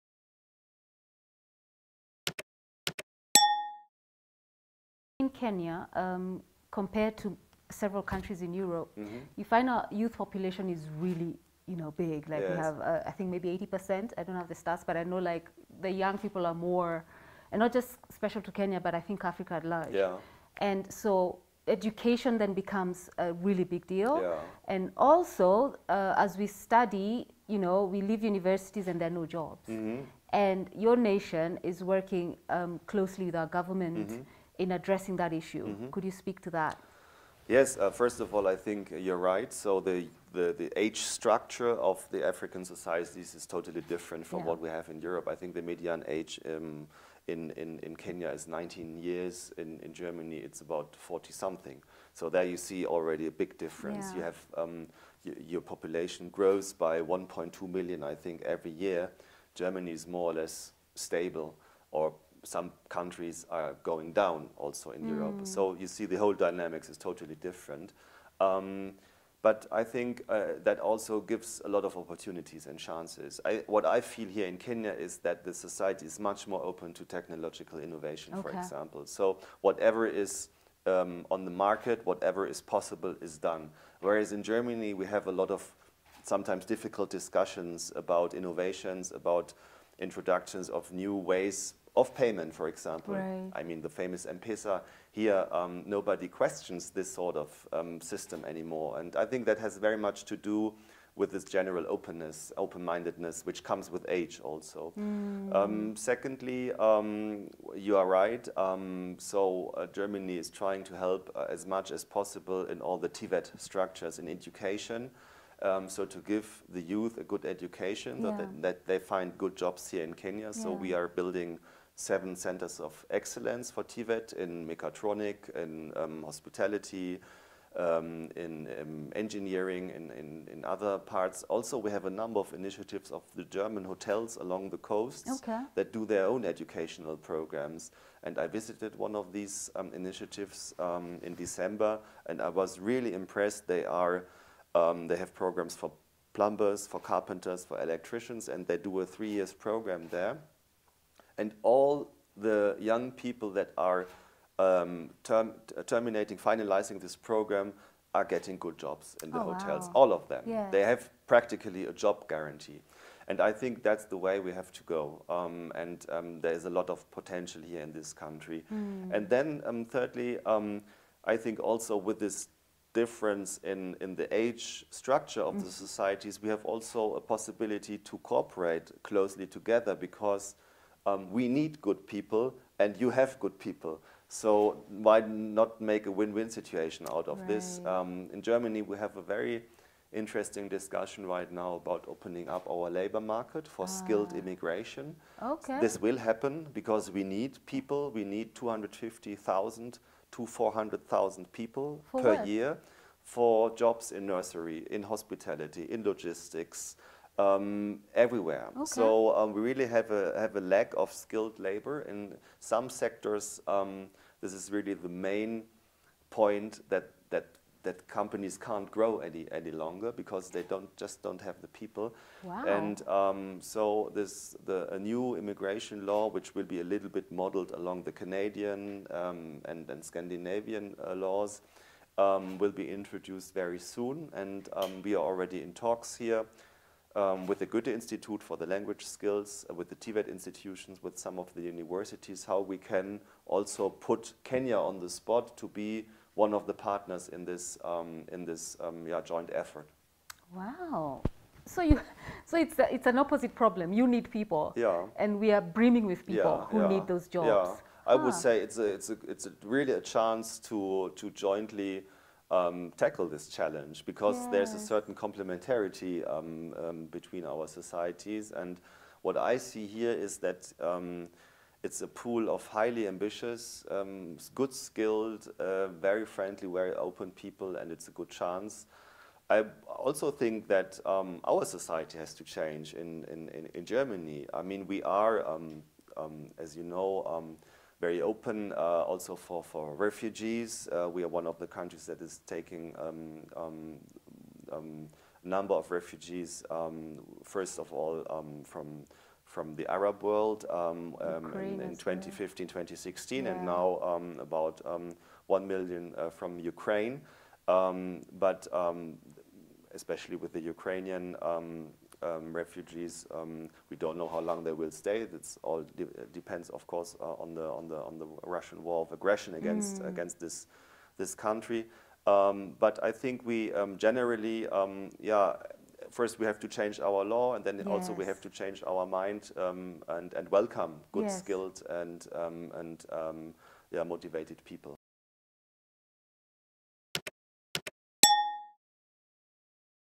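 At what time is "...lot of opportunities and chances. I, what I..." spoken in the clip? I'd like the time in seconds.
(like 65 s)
71 s.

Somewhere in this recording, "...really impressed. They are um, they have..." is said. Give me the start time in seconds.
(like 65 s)
142 s.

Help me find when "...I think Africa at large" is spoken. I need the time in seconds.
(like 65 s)
18 s.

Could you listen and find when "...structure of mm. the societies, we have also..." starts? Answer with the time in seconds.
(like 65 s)
174 s.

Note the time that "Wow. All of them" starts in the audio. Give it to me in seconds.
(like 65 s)
159 s.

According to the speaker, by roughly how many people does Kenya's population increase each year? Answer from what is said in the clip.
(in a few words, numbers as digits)
1.2 million.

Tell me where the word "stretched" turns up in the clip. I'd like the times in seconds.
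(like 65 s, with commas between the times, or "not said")
not said.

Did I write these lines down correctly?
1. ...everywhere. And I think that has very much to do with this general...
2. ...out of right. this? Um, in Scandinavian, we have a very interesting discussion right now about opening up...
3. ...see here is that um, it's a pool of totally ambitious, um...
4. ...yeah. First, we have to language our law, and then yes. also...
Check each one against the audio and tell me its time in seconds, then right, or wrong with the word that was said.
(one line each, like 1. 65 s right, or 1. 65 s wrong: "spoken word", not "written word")
1. 98 s wrong: "anymore", not "everywhere"
2. 187 s wrong: "Germany", not "Scandinavian"
3. 269 s wrong: "highly", not "totally"
4. 325 s wrong: "change", not "language".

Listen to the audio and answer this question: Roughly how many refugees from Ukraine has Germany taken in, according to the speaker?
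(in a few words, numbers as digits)
1 million.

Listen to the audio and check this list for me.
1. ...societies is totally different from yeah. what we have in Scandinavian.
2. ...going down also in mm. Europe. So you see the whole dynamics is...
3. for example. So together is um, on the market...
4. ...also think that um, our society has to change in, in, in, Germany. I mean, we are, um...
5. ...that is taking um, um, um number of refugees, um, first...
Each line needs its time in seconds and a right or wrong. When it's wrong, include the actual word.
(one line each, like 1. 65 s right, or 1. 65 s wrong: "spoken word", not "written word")
1. 42 s wrong: "Europe", not "Scandinavian"
2. 63 s right
3. 78 s wrong: "whatever", not "together"
4. 279 s right
5. 292 s right.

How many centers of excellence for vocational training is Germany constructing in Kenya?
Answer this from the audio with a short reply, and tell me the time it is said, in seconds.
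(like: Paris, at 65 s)
7, at 122 s.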